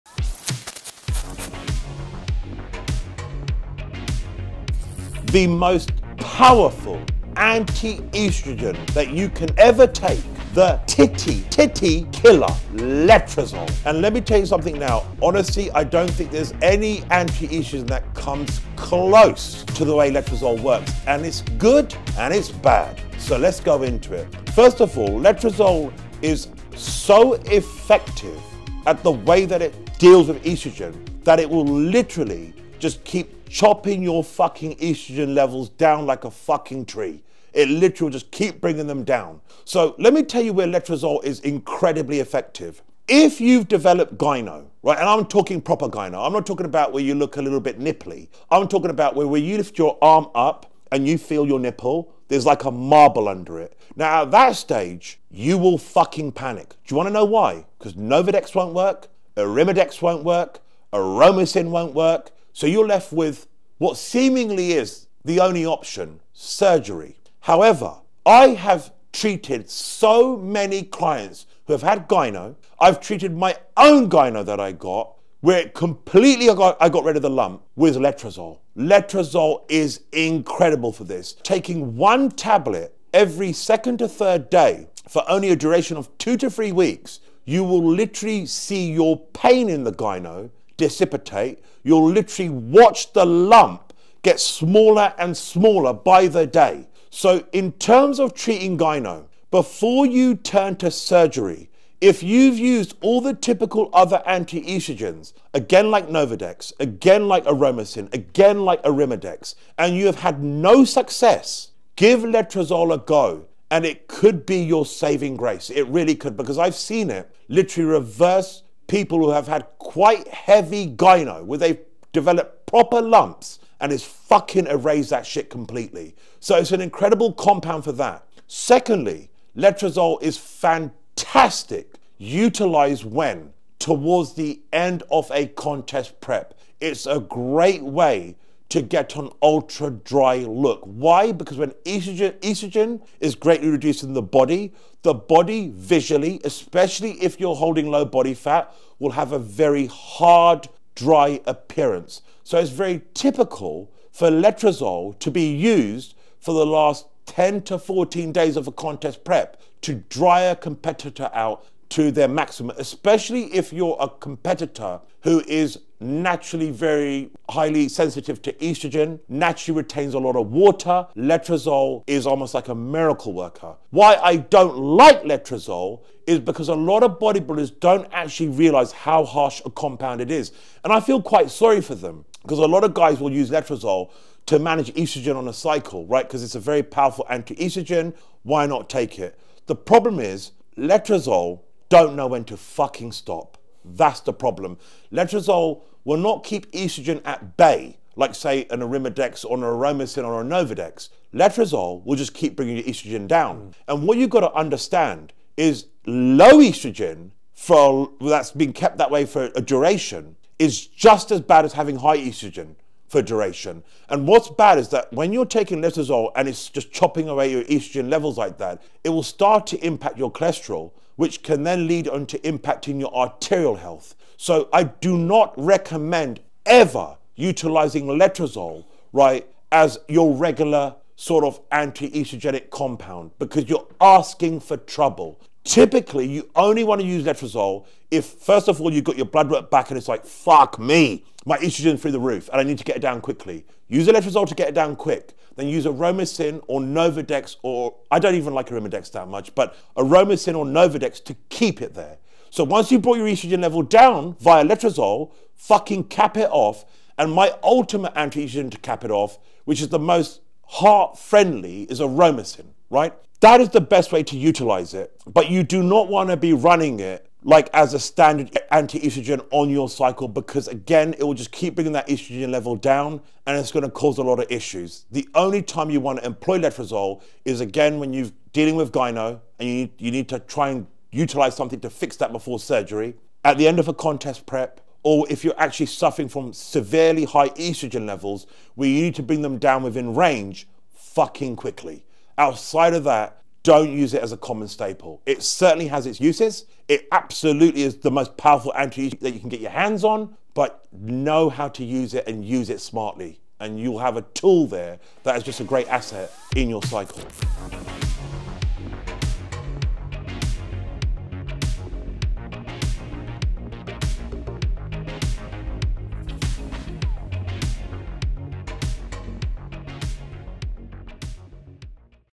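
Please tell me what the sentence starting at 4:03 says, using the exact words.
Use a letrozole to get it down quick.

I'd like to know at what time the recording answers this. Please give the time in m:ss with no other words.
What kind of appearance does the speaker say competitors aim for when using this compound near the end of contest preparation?
2:19.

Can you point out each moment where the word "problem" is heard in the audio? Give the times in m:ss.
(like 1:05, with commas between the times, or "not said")
3:09, 3:14.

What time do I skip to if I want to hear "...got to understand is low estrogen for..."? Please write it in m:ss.
3:24.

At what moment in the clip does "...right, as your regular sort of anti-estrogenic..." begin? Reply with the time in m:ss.
3:49.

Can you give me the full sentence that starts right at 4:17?
And my ultimate anti-estrogen to cap it off, which is the most heart friendly is aromasin, right?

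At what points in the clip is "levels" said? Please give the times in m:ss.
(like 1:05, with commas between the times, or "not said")
0:35, 3:38, 4:13, 4:32, 4:48.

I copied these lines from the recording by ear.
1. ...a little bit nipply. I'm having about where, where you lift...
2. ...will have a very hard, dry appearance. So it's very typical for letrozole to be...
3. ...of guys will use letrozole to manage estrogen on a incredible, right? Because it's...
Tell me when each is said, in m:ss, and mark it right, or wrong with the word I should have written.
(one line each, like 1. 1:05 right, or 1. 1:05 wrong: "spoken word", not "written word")
1. 0:47 wrong: "talking", not "having"
2. 2:28 right
3. 3:02 wrong: "cycle", not "incredible".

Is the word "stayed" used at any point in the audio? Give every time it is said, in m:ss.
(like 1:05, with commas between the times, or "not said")
not said.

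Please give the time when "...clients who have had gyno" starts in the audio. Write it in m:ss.
1:10.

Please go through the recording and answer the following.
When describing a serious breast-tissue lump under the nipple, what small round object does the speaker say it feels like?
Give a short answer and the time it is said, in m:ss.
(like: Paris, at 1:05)
a marble, at 0:52.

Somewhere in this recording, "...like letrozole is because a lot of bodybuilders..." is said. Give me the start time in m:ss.
2:54.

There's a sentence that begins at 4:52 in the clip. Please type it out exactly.
Outside of that, don't use it as a common staple.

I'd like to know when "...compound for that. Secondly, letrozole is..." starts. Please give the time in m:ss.
2:07.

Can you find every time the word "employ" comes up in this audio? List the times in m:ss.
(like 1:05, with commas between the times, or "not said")
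4:36.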